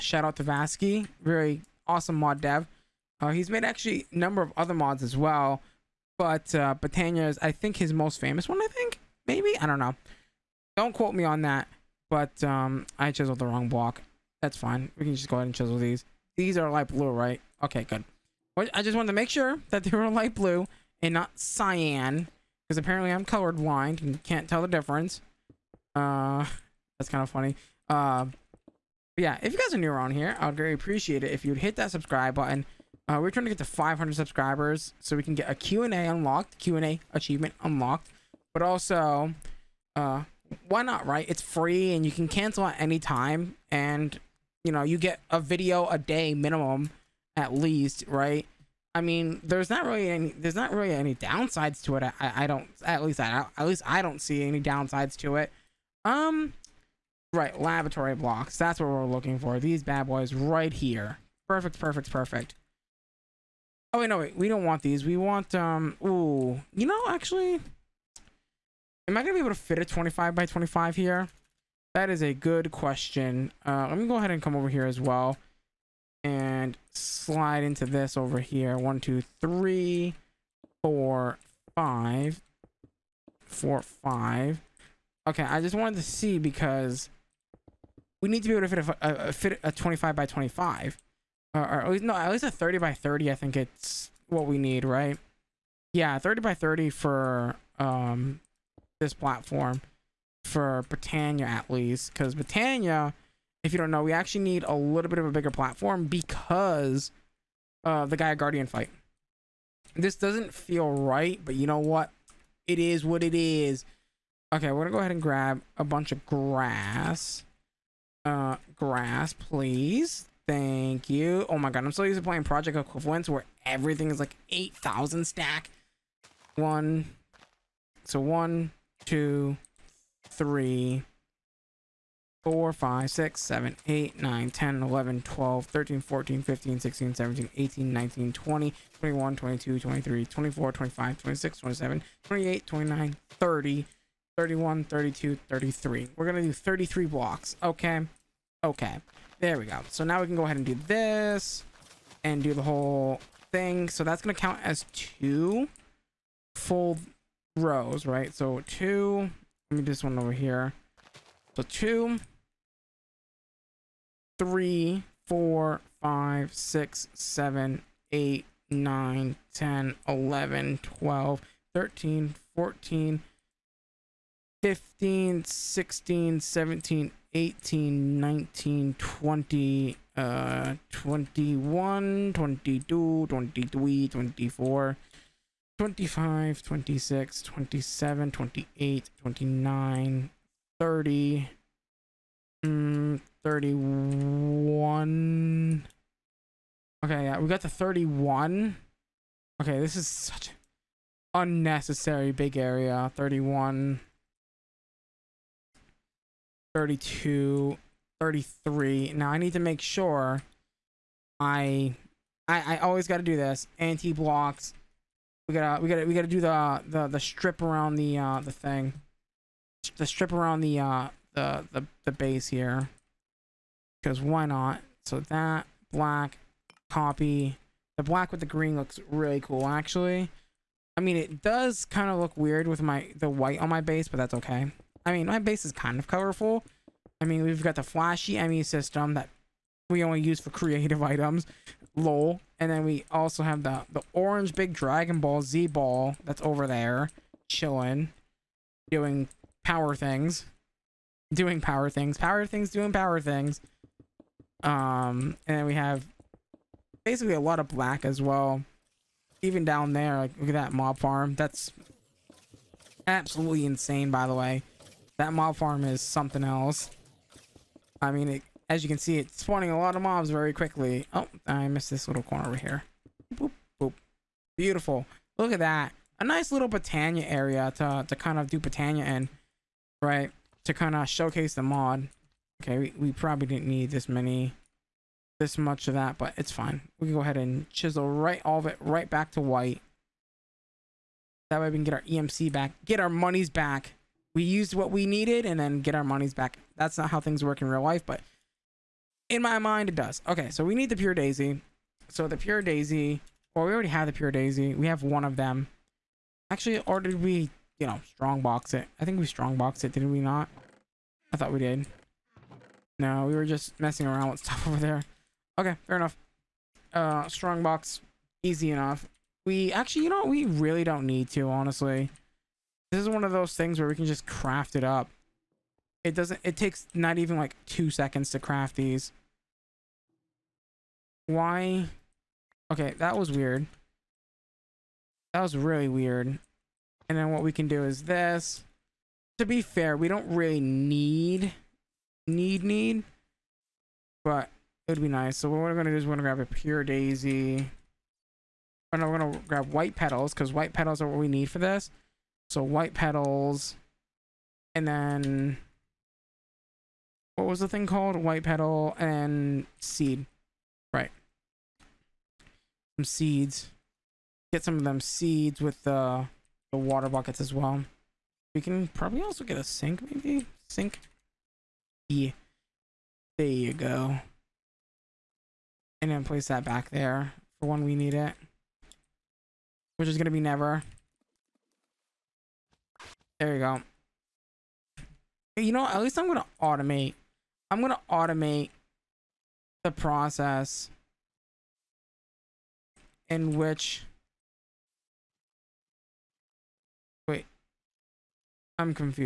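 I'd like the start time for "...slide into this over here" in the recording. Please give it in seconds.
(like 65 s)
76 s.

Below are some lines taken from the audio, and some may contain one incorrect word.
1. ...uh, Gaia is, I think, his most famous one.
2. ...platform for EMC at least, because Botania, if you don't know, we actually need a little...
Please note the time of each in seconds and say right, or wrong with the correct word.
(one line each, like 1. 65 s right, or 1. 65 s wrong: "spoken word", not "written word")
1. 6 s wrong: "Botania", not "Gaia"
2. 99 s wrong: "Botania", not "EMC".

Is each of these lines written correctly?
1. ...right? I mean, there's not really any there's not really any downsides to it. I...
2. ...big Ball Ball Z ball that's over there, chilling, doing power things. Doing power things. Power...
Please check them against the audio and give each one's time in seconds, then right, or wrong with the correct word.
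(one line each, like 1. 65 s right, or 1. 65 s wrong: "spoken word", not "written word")
1. 48 s right
2. 244 s wrong: "Dragon", not "Ball".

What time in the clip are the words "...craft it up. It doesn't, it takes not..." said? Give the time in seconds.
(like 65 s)
324 s.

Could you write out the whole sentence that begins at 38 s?
But also, uh, why not, right?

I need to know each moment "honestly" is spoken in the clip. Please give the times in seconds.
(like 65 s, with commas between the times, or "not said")
321 s.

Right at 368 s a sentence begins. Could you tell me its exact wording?
We can probably also get a sink, maybe?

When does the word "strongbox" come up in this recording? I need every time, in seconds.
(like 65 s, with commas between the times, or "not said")
308 s, 317 s.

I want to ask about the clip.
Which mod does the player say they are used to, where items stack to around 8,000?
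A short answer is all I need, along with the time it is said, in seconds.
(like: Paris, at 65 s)
Project Equivalence, at 122 s.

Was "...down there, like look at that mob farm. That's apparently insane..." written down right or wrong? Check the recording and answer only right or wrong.
wrong.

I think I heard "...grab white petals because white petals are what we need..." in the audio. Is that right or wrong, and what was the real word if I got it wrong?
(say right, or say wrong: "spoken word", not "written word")
right.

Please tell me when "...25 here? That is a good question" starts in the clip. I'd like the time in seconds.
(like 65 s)
70 s.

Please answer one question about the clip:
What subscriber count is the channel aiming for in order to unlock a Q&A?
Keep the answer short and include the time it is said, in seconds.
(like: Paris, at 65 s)
500, at 33 s.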